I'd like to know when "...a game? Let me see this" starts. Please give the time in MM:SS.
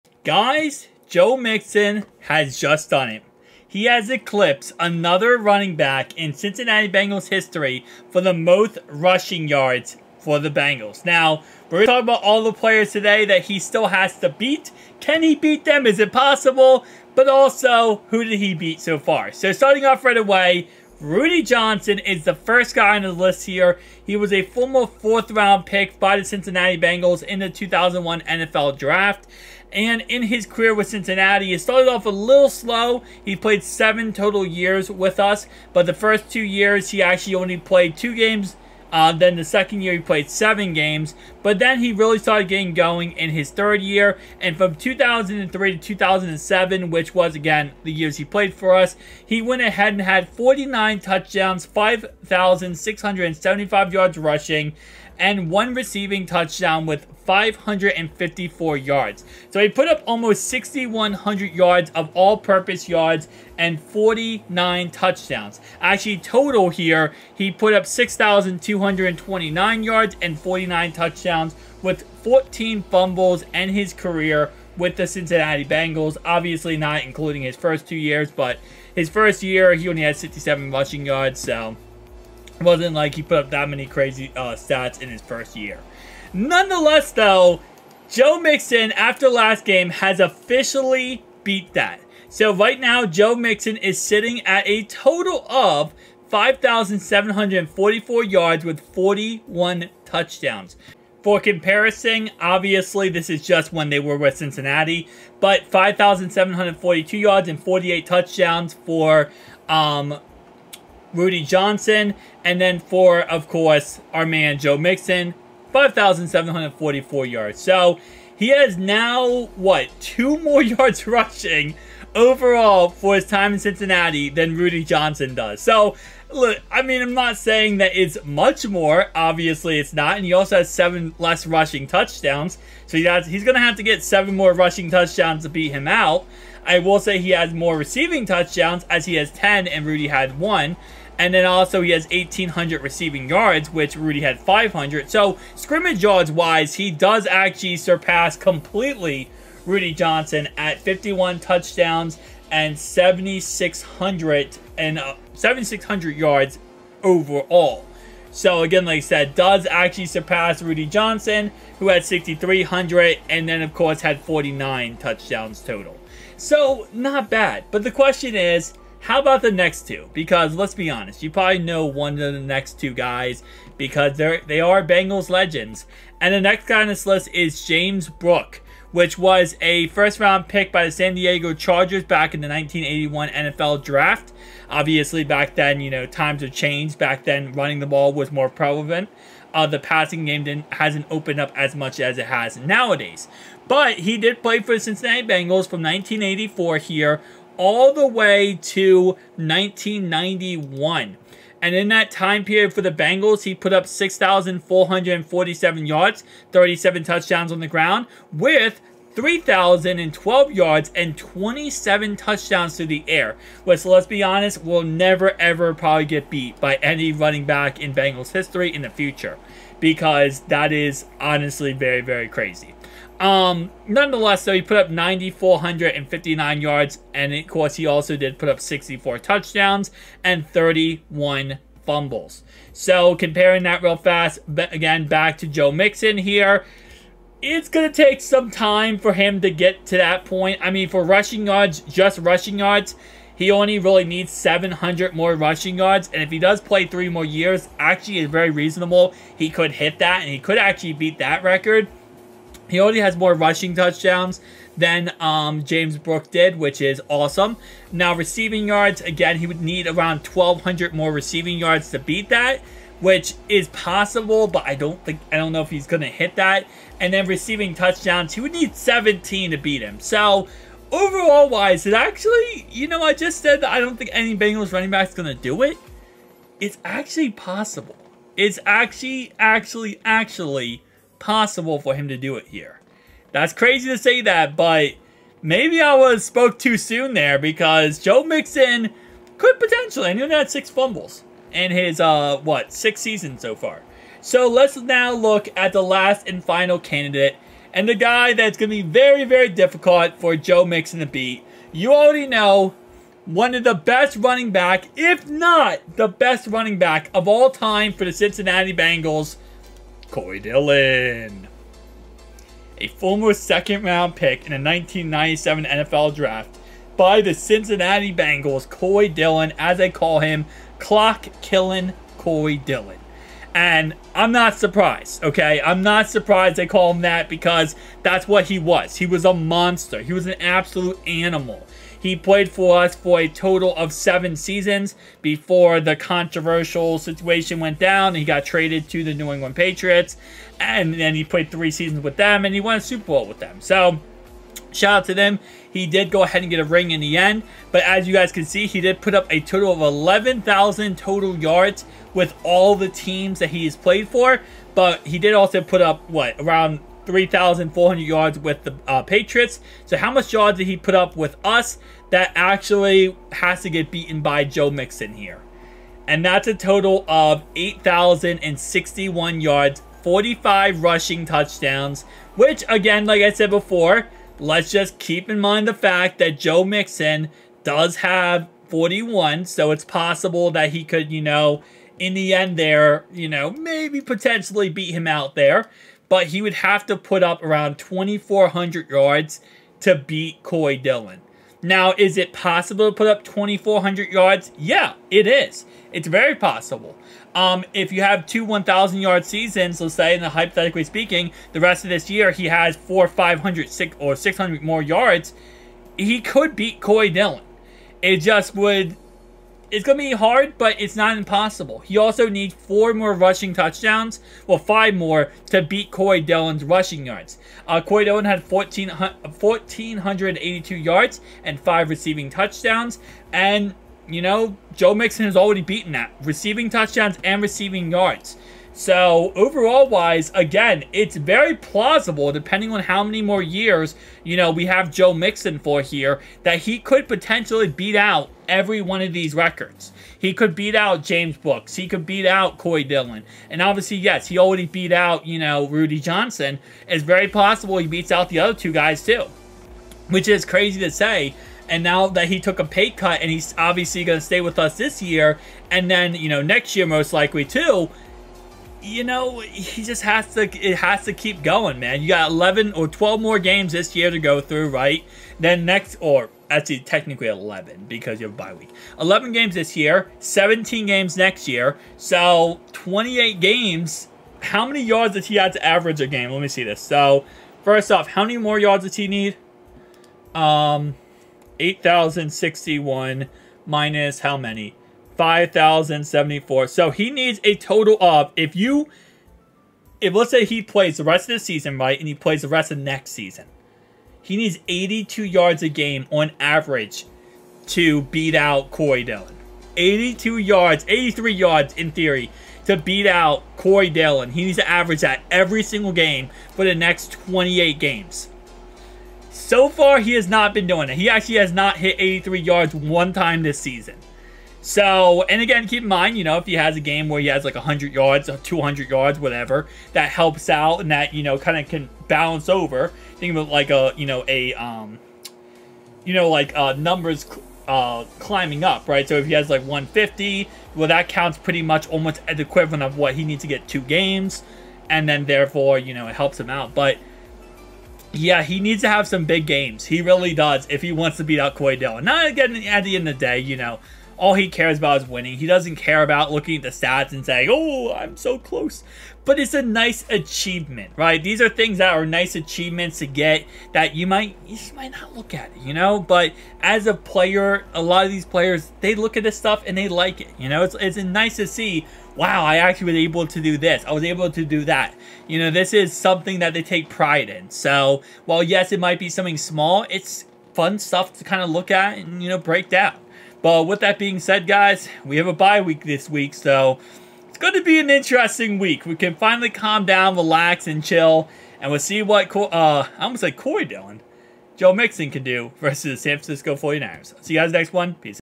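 07:56.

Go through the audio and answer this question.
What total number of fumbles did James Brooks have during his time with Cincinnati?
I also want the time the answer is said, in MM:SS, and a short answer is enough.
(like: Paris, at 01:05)
31, at 03:50.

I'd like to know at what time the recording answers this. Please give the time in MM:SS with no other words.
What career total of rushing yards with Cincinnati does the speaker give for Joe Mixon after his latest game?
01:36.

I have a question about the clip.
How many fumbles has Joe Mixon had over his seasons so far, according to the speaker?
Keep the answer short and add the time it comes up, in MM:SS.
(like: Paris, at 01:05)
6, at 04:50.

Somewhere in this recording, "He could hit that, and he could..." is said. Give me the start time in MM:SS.
04:09.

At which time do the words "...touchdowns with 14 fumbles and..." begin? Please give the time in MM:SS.
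01:10.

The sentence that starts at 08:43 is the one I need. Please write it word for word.
Think of it like a, you know, a, um, you know, like uh, numbers uh, climbing up, right?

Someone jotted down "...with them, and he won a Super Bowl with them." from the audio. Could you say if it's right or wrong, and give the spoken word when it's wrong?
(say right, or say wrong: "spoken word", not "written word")
right.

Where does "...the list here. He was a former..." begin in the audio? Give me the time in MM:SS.
00:23.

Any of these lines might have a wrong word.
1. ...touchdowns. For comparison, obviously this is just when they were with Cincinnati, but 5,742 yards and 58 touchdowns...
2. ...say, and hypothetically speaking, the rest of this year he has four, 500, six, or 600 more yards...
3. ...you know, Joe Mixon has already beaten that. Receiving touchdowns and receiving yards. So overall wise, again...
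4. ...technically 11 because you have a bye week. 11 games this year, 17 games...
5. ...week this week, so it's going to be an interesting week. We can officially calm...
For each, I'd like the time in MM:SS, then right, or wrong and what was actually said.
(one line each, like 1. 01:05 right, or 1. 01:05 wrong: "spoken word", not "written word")
1. 01:40 wrong: "48", not "58"
2. 06:39 right
3. 07:04 right
4. 07:46 right
5. 09:35 wrong: "finally", not "officially".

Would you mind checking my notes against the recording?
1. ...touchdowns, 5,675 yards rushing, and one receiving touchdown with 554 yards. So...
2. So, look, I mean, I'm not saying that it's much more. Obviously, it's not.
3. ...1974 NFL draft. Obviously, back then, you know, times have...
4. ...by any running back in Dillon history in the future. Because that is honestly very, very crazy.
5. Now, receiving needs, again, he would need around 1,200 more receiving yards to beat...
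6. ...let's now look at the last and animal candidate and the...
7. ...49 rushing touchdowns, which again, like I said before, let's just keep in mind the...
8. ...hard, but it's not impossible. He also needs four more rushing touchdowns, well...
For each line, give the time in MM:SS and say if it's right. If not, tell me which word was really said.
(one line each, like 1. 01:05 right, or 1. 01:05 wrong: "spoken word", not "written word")
1. 00:50 right
2. 02:05 right
3. 03:02 wrong: "1981", not "1974"
4. 03:36 wrong: "Bengals", not "Dillon"
5. 04:17 wrong: "yards", not "needs"
6. 04:54 wrong: "final", not "animal"
7. 06:10 wrong: "45", not "49"
8. 06:50 right.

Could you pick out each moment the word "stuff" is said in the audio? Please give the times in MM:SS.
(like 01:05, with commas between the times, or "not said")
09:19, 09:30.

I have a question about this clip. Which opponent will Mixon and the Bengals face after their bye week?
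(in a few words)
San Francisco 49ers.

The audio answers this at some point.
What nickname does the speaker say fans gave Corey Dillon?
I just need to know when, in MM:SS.
05:20.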